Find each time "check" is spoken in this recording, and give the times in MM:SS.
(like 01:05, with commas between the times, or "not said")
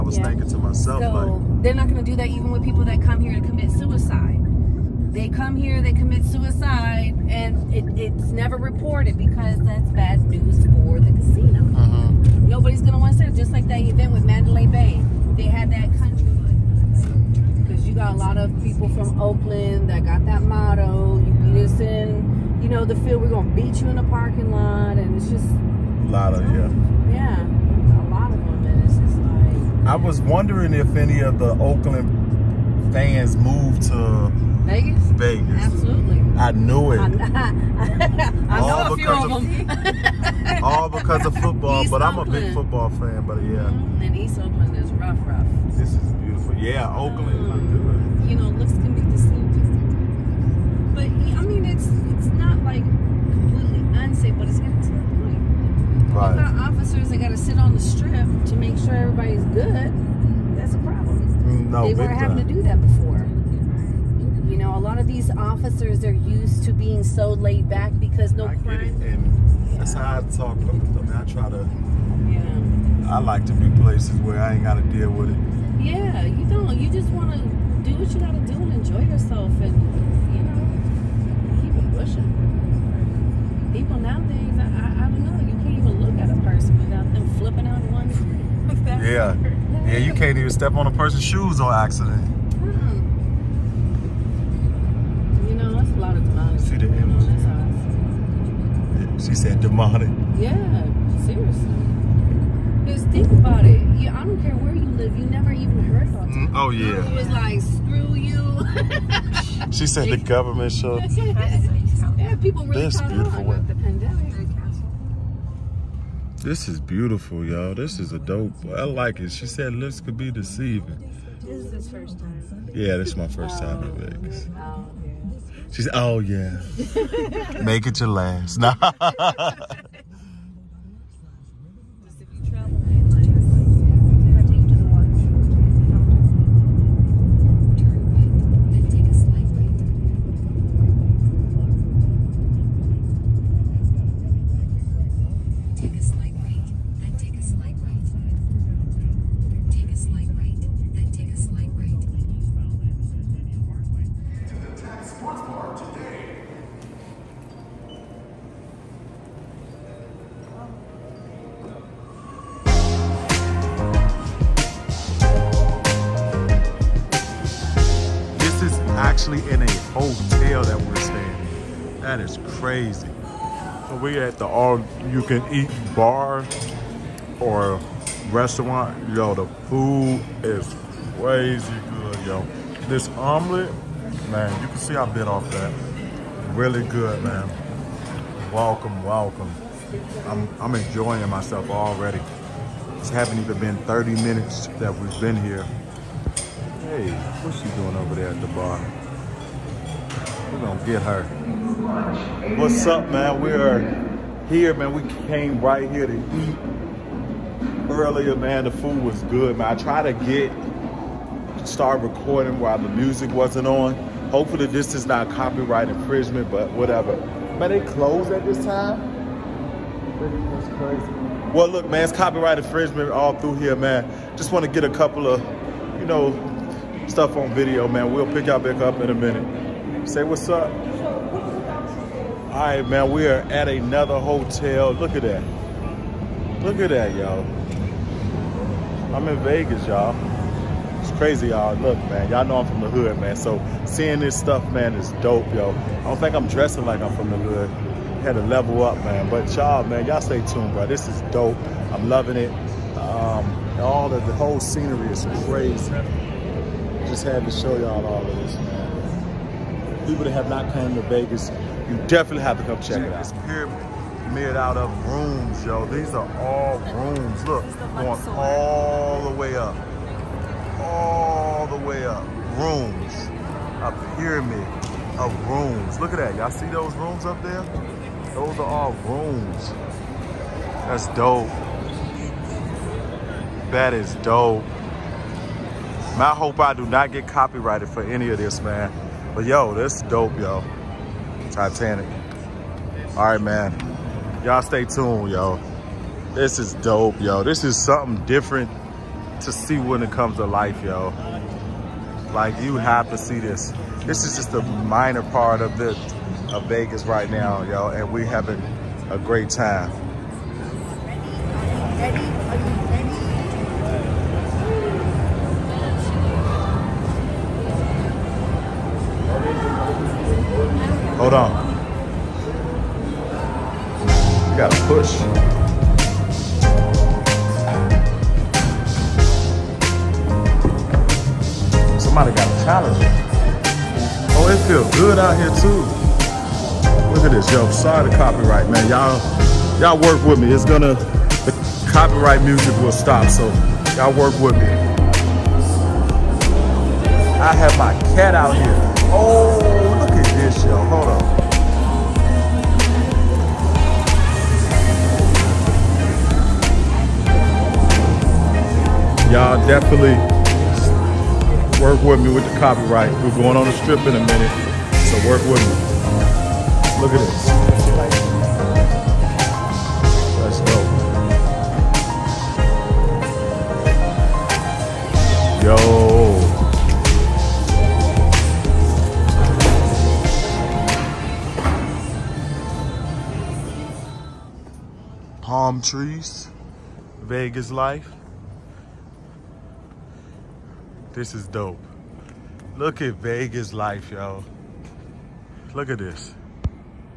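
04:22.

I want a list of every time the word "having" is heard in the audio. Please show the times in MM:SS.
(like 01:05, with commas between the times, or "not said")
01:02, 05:08.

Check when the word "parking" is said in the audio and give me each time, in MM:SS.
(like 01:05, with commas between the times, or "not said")
00:24.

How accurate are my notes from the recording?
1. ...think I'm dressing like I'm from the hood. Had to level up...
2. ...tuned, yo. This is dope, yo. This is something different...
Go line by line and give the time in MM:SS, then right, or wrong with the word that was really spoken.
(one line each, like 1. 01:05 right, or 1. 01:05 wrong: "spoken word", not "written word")
1. 04:06 right
2. 04:54 right.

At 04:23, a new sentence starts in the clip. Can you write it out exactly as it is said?
It's pyramid out of rooms, yo.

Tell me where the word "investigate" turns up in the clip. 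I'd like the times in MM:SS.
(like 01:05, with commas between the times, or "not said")
not said.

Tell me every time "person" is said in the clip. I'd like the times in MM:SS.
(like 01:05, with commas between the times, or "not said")
01:26, 01:30.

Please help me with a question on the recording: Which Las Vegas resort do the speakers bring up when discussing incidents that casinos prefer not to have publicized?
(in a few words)
Mandalay Bay.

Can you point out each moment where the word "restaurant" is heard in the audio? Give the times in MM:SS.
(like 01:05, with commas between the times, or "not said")
02:58.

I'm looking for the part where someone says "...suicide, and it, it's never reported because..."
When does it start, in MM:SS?
00:06.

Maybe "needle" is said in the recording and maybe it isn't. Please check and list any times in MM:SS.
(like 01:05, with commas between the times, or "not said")
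not said.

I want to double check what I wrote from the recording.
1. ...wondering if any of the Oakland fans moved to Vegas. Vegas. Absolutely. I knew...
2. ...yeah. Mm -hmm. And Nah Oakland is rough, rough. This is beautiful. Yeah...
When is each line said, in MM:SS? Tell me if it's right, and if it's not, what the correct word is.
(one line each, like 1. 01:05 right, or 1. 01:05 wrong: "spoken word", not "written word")
1. 00:30 right
2. 00:43 wrong: "East", not "Nah".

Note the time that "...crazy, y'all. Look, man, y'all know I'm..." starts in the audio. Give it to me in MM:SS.
04:01.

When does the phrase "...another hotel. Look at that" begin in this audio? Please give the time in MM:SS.
03:53.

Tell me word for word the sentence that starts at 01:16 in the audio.
You just want to do what you got to do and enjoy yourself, and you know, keep it pushing.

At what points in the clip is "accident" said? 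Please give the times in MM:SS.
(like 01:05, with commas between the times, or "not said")
01:31.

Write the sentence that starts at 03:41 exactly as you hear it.
Well, look, man, it's copyright infringement all through here, man.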